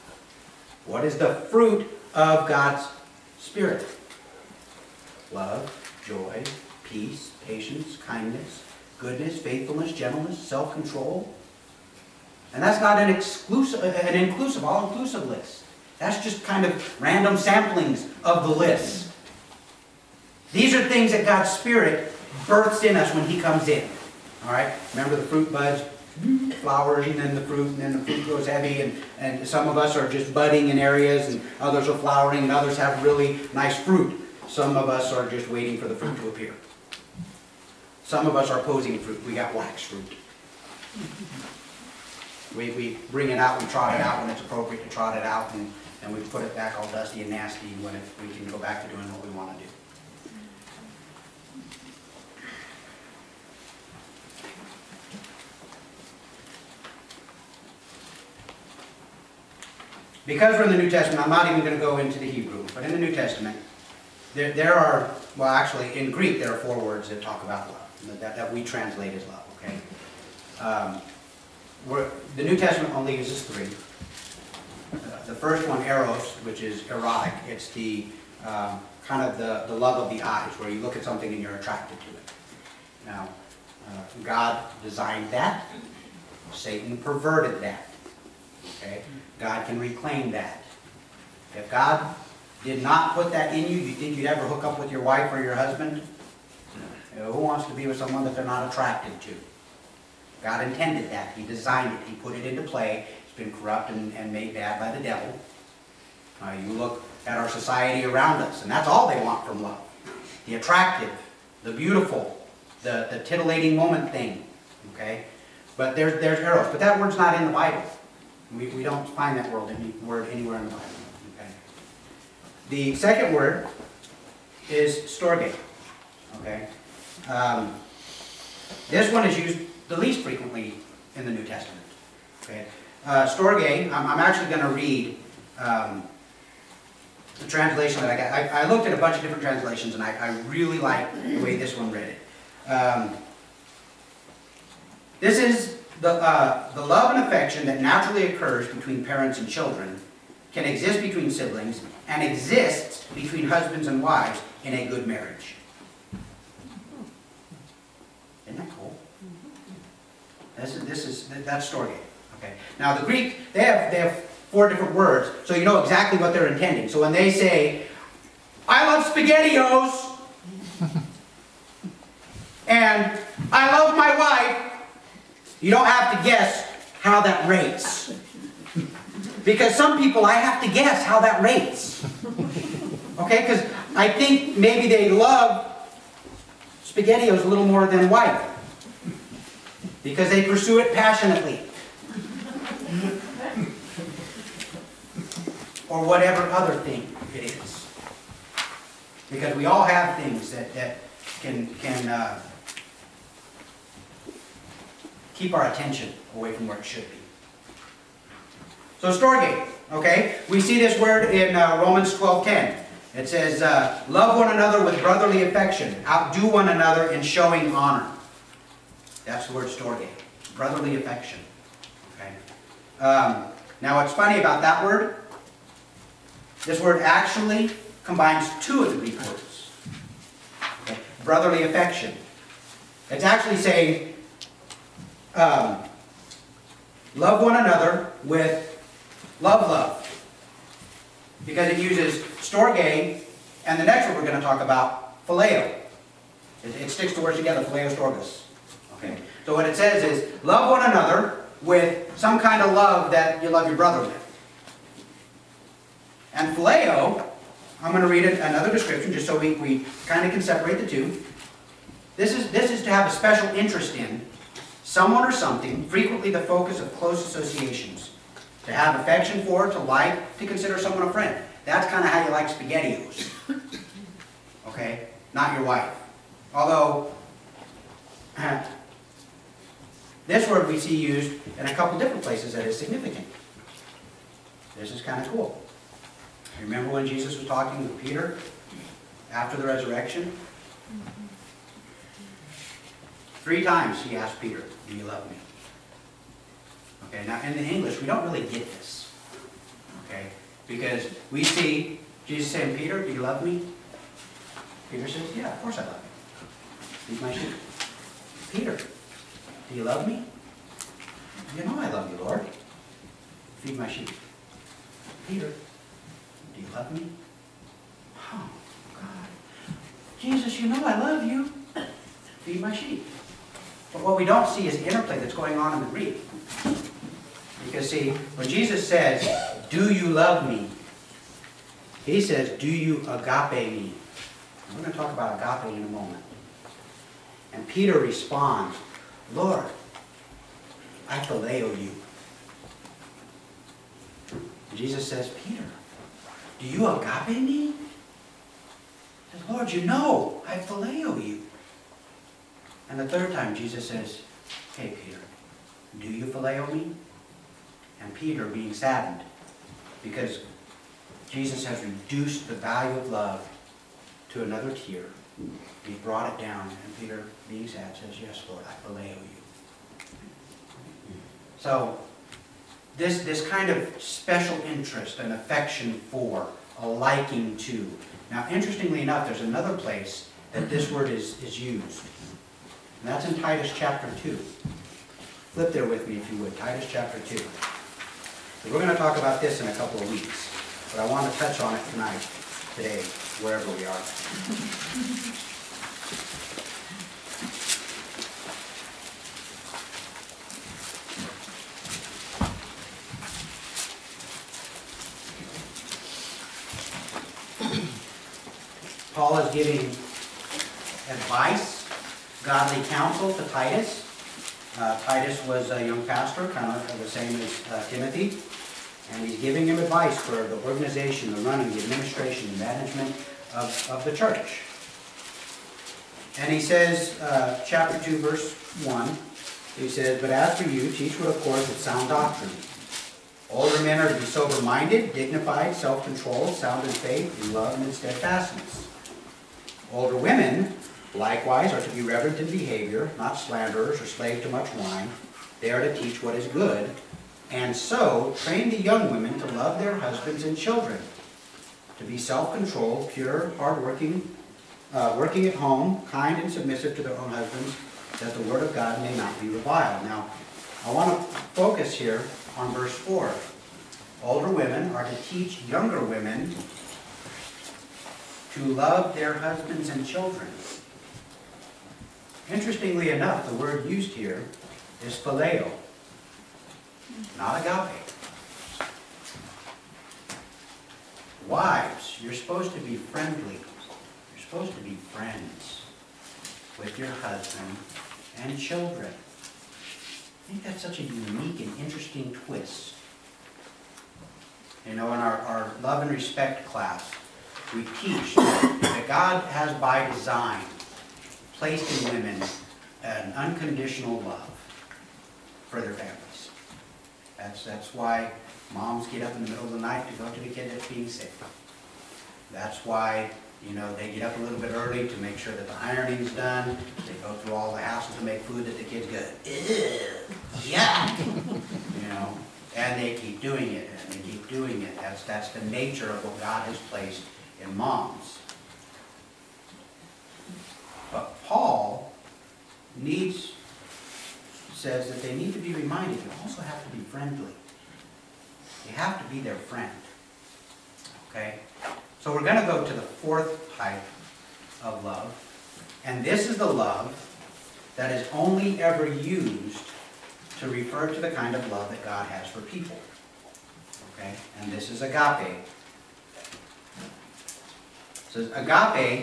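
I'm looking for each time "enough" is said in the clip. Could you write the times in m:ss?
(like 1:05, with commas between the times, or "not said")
6:19, 7:53.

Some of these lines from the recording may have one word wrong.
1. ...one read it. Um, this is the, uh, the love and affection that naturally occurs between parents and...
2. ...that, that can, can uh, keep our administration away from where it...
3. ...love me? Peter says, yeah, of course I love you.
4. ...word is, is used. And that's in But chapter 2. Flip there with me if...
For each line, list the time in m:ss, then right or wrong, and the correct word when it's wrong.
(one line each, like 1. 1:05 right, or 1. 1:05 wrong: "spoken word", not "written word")
1. 2:21 right
2. 3:20 wrong: "attention", not "administration"
3. 5:03 right
4. 6:20 wrong: "Titus", not "But".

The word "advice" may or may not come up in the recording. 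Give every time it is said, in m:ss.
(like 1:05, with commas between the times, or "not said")
6:51, 6:59.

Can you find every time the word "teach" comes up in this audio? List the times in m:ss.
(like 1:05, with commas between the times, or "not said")
7:10, 7:25, 7:45, 8:17.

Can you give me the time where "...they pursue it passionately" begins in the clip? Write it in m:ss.
3:10.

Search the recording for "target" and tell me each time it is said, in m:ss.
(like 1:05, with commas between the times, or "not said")
not said.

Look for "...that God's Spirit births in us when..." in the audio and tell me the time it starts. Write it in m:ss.
0:21.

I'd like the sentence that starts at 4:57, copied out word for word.
Okay, now in the English, we don't really get this.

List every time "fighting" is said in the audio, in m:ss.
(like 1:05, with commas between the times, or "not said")
not said.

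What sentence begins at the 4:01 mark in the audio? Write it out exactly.
Because it uses storge, and the next one we're going to talk about, phileo.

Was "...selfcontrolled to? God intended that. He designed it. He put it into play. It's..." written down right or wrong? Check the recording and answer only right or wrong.
wrong.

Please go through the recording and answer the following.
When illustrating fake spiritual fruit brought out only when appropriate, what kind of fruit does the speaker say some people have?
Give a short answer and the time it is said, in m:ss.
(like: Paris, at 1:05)
wax fruit, at 0:39.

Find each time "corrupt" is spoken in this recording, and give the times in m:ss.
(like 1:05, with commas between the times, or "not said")
1:43.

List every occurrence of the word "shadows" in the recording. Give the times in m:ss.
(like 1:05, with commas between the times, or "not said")
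not said.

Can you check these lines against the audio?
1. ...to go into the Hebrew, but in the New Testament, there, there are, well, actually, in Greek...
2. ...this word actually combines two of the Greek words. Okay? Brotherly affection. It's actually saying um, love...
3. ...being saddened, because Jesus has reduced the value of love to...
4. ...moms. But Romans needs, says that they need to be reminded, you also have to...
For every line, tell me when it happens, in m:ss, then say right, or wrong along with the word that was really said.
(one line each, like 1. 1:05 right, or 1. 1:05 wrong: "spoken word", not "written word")
1. 1:01 right
2. 3:46 right
3. 5:58 right
4. 8:47 wrong: "Paul", not "Romans".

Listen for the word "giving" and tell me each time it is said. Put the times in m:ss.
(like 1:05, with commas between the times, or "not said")
6:49, 6:59.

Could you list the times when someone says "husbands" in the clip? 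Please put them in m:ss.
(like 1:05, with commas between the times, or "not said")
1:35, 2:33, 7:29, 7:37, 7:49, 8:07.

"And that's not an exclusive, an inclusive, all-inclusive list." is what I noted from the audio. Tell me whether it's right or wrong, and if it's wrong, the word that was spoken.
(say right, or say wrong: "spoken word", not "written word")
right.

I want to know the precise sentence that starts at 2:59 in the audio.
Because some people, I have to guess how that rates.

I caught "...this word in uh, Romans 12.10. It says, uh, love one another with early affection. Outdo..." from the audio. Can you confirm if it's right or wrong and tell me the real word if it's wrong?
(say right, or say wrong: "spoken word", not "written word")
wrong: "brotherly", not "early".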